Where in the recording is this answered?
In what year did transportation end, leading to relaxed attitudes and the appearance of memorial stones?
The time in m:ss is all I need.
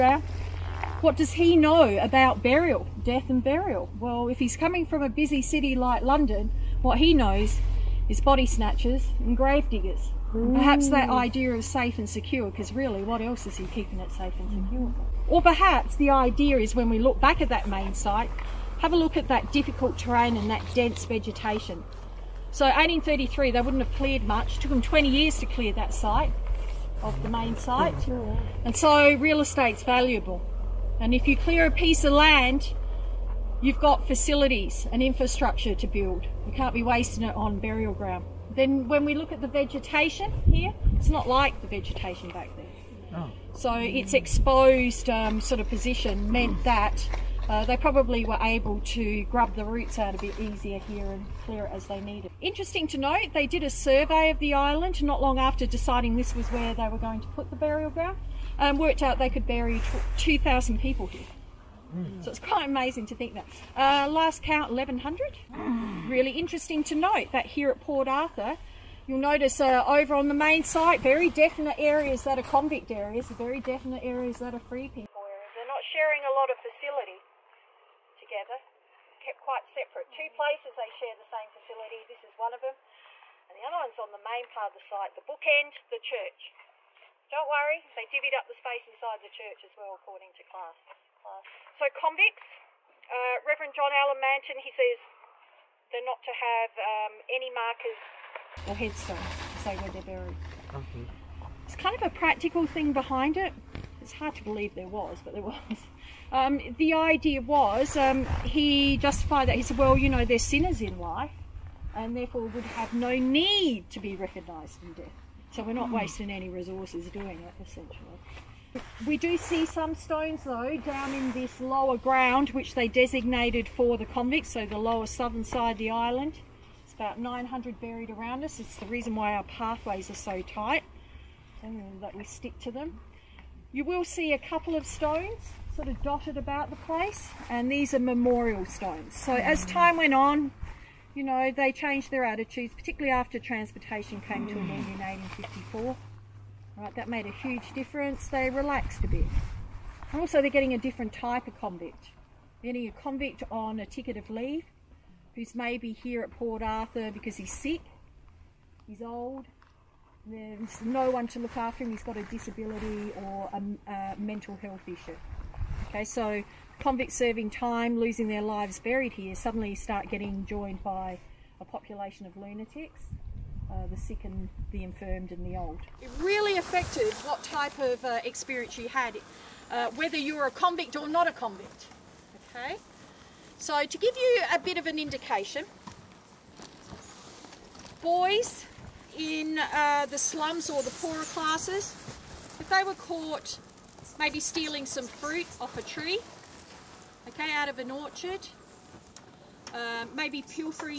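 2:24.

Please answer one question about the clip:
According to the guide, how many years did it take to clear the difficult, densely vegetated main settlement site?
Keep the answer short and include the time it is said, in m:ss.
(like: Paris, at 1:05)
20 years, at 0:24.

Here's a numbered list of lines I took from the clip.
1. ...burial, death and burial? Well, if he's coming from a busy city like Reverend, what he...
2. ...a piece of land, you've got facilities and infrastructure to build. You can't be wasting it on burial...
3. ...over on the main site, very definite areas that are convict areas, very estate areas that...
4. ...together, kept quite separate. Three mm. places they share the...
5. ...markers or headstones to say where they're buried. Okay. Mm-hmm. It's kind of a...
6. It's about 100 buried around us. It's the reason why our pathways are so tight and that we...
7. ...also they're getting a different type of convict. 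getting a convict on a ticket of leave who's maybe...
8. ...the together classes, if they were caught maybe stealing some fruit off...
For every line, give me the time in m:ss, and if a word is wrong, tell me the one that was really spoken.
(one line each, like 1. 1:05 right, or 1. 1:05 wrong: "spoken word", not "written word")
1. 0:02 wrong: "London", not "Reverend"
2. 0:31 right
3. 1:09 wrong: "definite", not "estate"
4. 1:18 wrong: "Two", not "Three"
5. 1:37 right
6. 2:06 wrong: "900", not "100"
7. 2:30 right
8. 3:10 wrong: "poorer", not "together".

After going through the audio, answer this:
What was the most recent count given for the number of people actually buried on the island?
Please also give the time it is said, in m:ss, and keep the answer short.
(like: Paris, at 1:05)
1,100, at 1:04.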